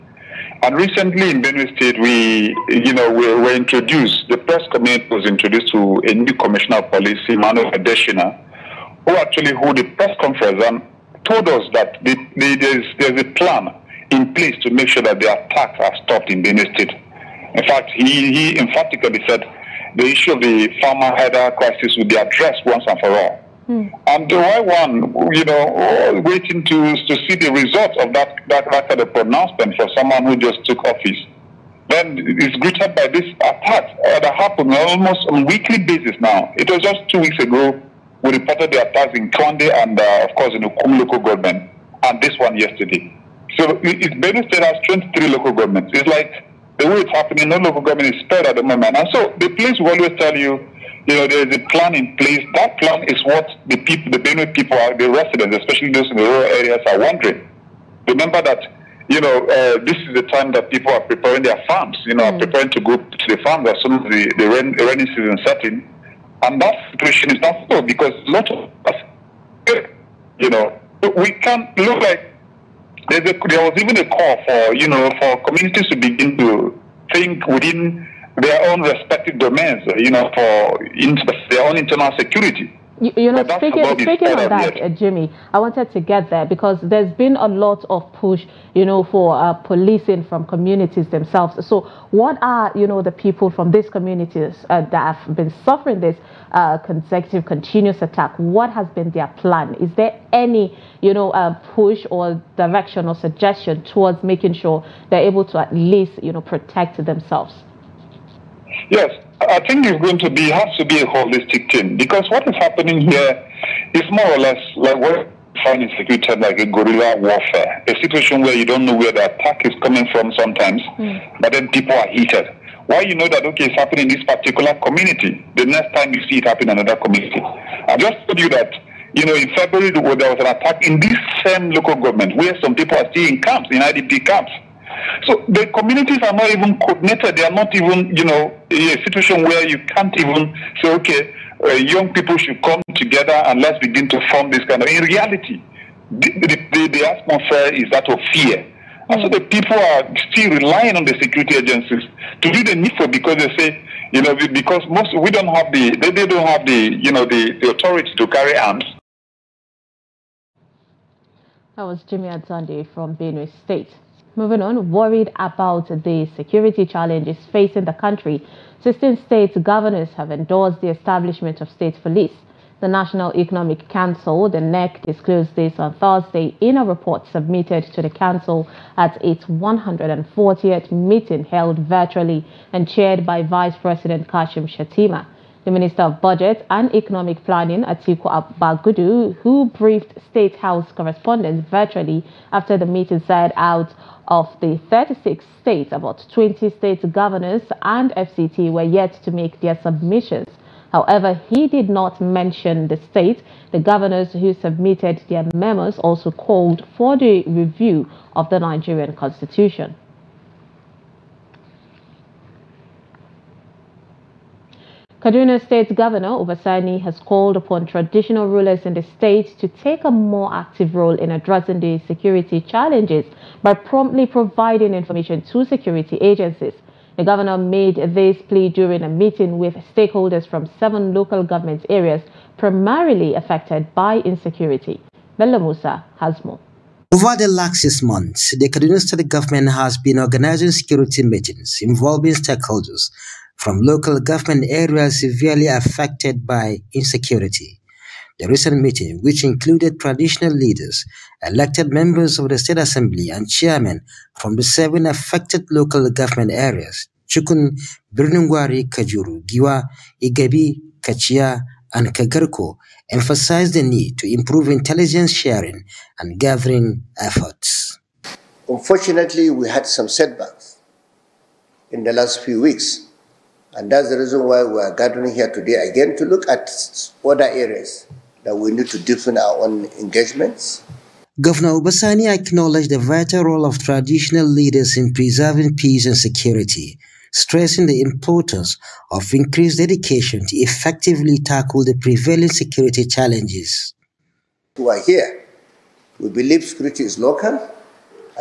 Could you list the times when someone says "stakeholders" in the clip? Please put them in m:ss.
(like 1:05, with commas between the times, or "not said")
3:49, 4:02.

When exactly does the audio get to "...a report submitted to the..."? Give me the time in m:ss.
2:56.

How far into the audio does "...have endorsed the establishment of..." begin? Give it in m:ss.
2:50.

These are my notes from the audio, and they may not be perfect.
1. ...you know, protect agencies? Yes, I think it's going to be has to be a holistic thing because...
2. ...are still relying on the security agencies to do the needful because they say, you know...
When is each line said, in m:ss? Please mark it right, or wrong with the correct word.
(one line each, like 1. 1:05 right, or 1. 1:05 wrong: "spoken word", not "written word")
1. 1:46 wrong: "themselves", not "agencies"
2. 2:29 right.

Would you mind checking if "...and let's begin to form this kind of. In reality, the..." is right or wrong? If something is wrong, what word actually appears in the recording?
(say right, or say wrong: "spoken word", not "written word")
right.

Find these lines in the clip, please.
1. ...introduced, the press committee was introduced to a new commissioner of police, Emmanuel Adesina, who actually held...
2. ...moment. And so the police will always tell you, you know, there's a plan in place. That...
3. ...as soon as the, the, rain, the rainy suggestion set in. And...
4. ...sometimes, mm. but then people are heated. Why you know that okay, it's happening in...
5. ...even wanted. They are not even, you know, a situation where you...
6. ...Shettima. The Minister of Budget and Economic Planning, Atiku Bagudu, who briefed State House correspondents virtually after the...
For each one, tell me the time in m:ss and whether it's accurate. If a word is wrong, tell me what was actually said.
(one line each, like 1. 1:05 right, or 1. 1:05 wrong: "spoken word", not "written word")
1. 0:03 right
2. 0:48 right
3. 1:03 wrong: "season", not "suggestion"
4. 2:00 right
5. 2:16 wrong: "coordinated", not "wanted"
6. 3:04 right.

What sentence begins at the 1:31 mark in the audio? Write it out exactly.
So what are, you know, the people from these communities uh, that have been suffering this uh, consecutive, continuous attack?